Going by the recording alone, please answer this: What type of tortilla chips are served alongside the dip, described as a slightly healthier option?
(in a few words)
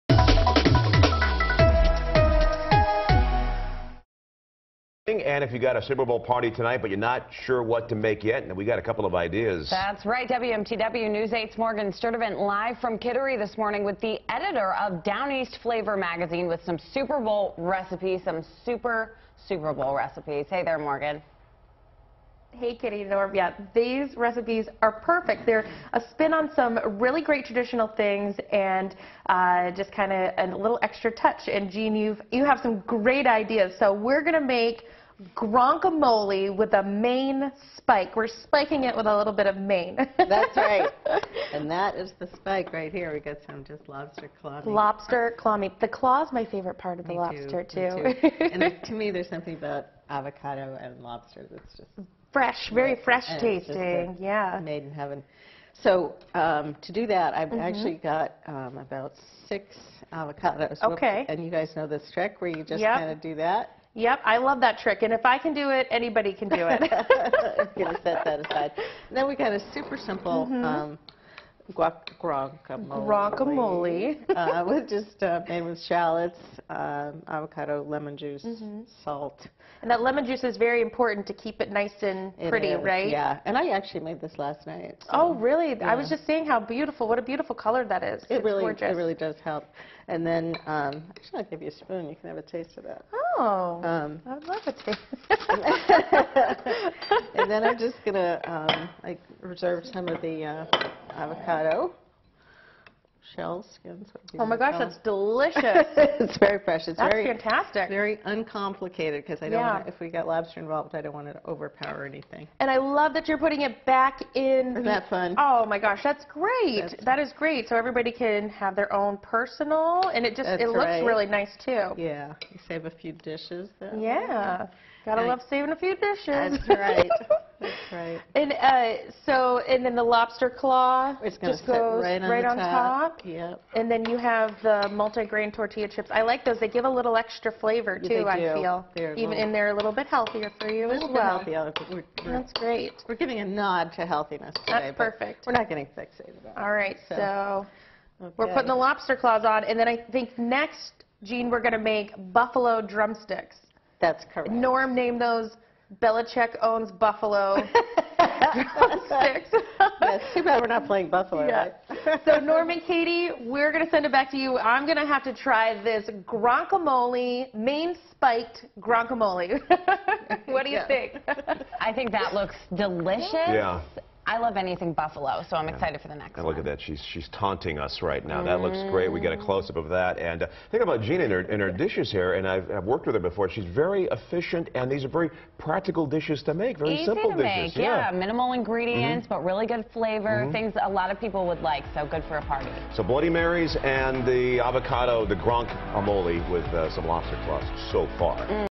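Multigrain.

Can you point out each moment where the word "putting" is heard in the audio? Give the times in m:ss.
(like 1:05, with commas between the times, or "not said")
1:53, 2:28.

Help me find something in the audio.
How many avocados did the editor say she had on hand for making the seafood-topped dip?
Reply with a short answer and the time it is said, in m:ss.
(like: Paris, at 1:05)
6, at 0:59.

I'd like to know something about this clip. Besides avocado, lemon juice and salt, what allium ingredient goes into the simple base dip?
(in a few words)
Shallots.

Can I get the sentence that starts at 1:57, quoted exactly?
So everybody can have their own personal, and it just that's it looks really nice too.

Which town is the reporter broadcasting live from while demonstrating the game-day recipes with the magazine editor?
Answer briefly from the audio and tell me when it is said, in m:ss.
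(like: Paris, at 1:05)
Kittery, at 0:12.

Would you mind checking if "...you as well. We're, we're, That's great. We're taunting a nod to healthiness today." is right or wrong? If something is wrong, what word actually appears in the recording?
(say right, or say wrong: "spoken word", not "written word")
wrong: "giving", not "taunting".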